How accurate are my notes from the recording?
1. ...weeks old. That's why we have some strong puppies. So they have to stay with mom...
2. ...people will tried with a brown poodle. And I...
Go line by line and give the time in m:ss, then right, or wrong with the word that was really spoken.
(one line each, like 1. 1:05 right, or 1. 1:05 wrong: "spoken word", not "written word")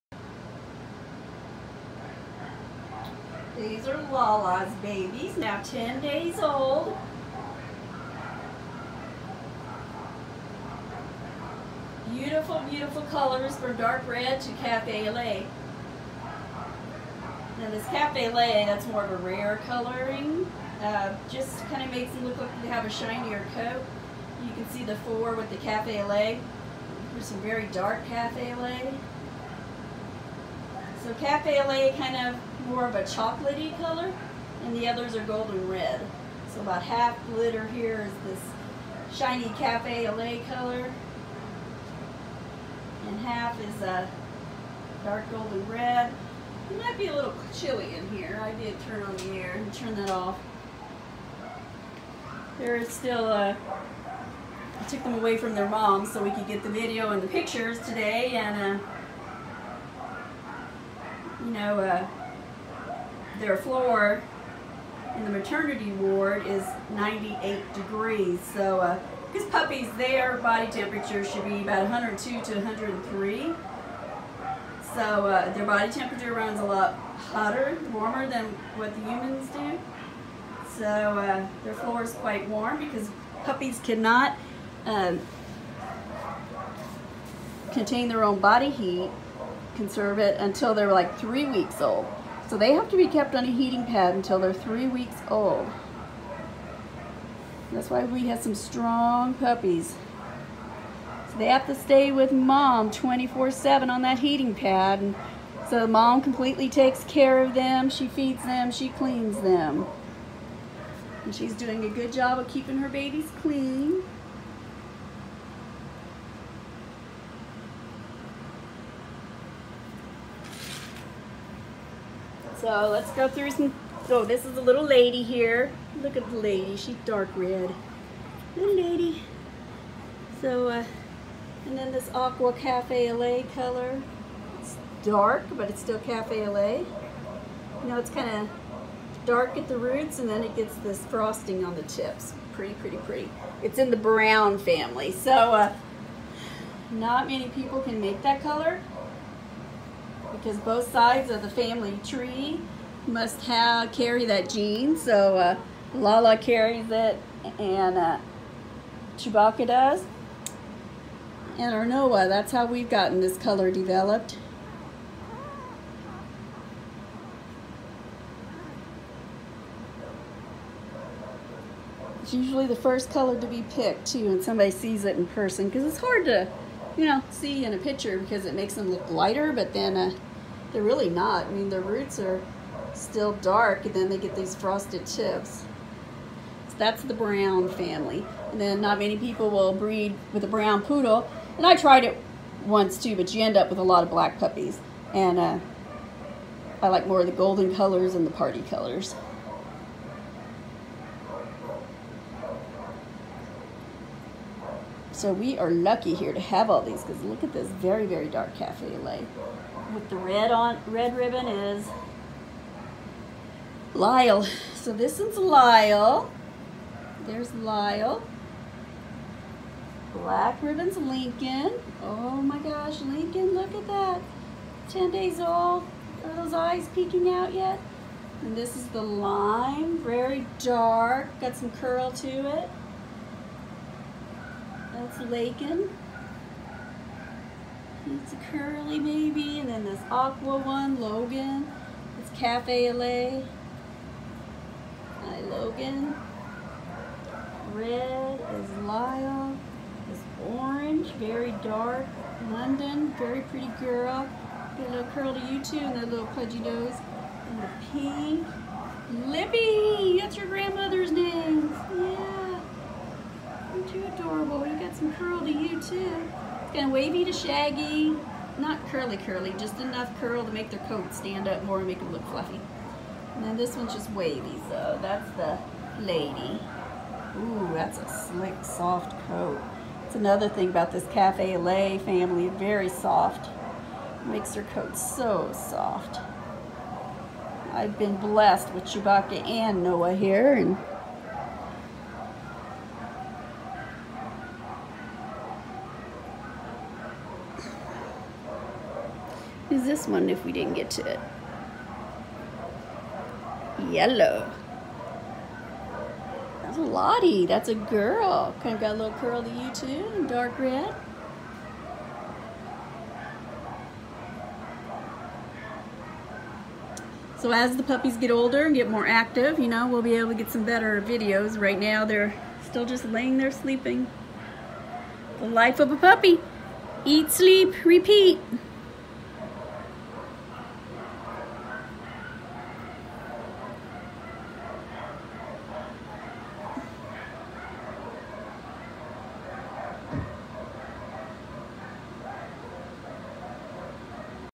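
1. 1:34 right
2. 3:09 wrong: "breed", not "tried".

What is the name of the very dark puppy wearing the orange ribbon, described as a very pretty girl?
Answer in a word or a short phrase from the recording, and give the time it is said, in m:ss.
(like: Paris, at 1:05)
London, at 4:12.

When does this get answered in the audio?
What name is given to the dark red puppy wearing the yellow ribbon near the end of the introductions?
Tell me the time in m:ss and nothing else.
5:06.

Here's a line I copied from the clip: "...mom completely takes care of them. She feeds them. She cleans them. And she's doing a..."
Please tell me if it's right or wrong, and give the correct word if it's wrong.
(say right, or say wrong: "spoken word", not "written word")
right.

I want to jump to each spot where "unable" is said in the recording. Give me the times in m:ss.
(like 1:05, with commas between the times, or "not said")
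not said.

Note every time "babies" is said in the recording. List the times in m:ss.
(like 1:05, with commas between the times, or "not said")
0:04, 1:52.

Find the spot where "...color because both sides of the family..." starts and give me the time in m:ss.
2:28.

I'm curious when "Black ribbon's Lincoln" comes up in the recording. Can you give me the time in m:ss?
3:40.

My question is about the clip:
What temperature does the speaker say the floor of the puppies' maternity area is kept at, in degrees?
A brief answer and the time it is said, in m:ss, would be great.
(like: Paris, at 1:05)
98, at 1:06.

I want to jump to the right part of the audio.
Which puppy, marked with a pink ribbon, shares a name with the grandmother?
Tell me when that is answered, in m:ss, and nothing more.
4:19.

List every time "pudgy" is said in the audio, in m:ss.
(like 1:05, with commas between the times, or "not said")
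4:16.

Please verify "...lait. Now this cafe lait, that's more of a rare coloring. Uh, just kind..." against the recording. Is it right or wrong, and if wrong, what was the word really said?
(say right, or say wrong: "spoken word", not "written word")
right.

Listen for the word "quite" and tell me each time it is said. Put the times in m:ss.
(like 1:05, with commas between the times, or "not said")
1:22.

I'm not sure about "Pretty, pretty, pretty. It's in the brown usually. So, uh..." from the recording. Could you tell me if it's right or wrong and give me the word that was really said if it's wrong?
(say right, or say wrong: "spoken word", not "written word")
wrong: "family", not "usually".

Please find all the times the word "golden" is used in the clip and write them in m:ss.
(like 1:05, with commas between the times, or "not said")
0:35, 0:45, 3:17.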